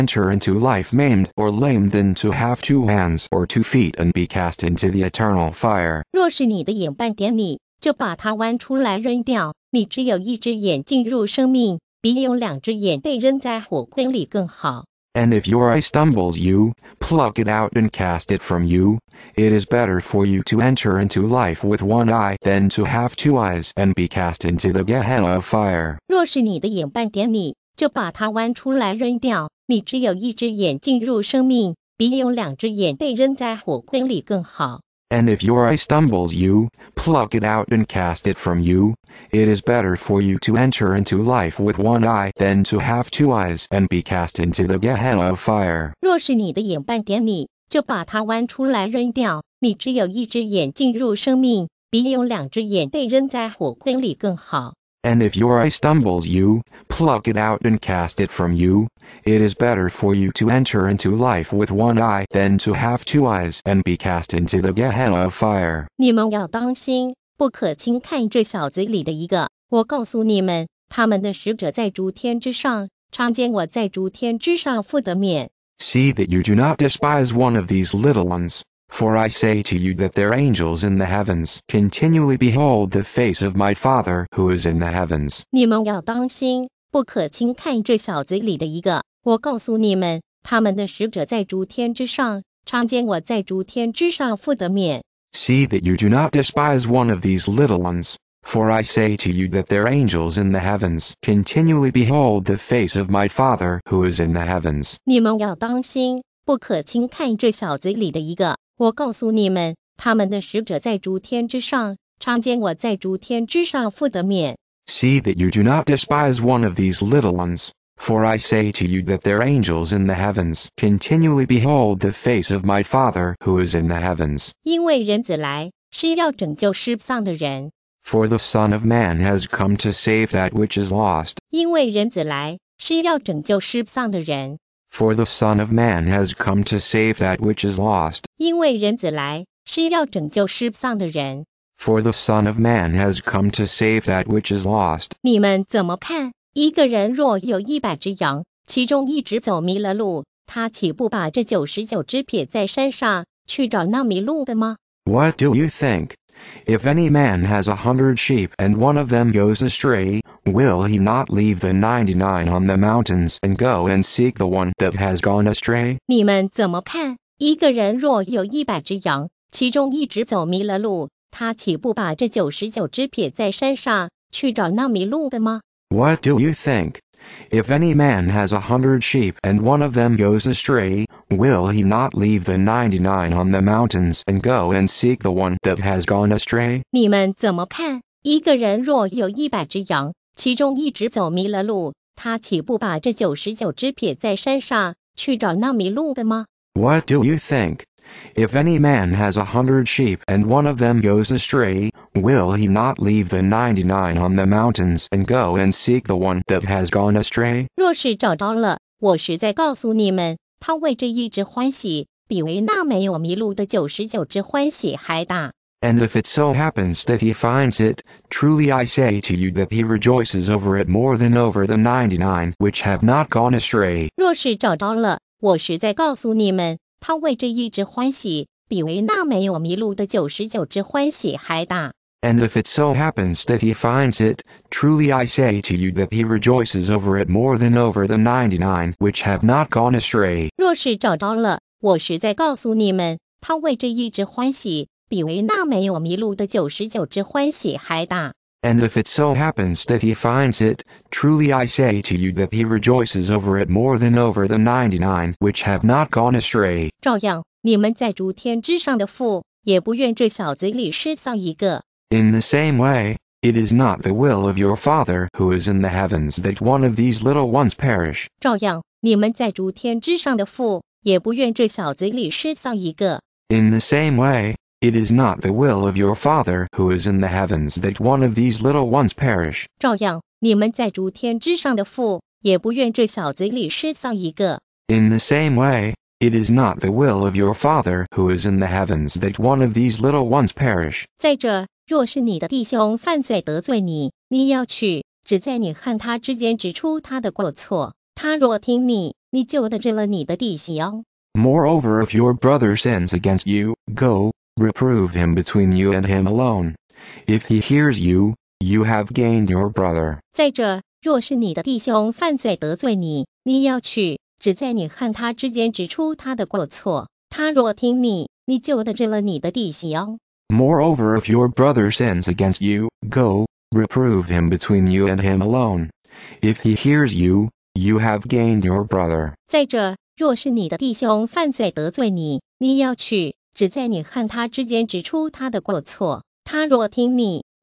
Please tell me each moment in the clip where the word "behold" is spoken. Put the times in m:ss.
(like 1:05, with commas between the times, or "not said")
1:22, 1:41, 2:01.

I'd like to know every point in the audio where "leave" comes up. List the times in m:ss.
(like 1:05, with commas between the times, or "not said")
2:41, 3:02, 3:22.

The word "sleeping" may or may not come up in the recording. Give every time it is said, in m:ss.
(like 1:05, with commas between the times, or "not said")
not said.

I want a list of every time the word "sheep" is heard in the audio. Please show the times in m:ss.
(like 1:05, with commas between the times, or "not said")
2:38, 2:59, 3:19.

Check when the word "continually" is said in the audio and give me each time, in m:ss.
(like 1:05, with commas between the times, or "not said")
1:21, 1:41, 2:00.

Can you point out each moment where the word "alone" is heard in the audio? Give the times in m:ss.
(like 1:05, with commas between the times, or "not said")
5:06, 5:25.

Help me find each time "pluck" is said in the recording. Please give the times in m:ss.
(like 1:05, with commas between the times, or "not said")
0:16, 0:37, 0:56.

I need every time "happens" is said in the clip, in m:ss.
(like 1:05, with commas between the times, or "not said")
3:36, 3:52, 4:09.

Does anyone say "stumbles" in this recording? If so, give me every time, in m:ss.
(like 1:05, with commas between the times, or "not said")
0:15, 0:35, 0:55.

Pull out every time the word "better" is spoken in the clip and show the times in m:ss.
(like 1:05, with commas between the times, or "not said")
0:19, 0:39, 0:59.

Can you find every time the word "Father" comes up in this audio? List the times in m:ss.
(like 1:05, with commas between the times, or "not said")
1:23, 1:43, 2:02, 4:24, 4:36, 4:47.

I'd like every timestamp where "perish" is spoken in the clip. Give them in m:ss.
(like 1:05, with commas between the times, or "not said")
4:27, 4:39, 4:50.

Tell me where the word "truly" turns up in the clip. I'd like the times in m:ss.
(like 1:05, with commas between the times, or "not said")
3:38, 3:54, 4:11.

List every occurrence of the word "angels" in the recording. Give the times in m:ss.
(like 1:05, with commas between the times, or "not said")
1:20, 1:39, 1:59.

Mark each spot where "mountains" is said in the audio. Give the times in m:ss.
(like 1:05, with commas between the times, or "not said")
2:42, 3:03, 3:24.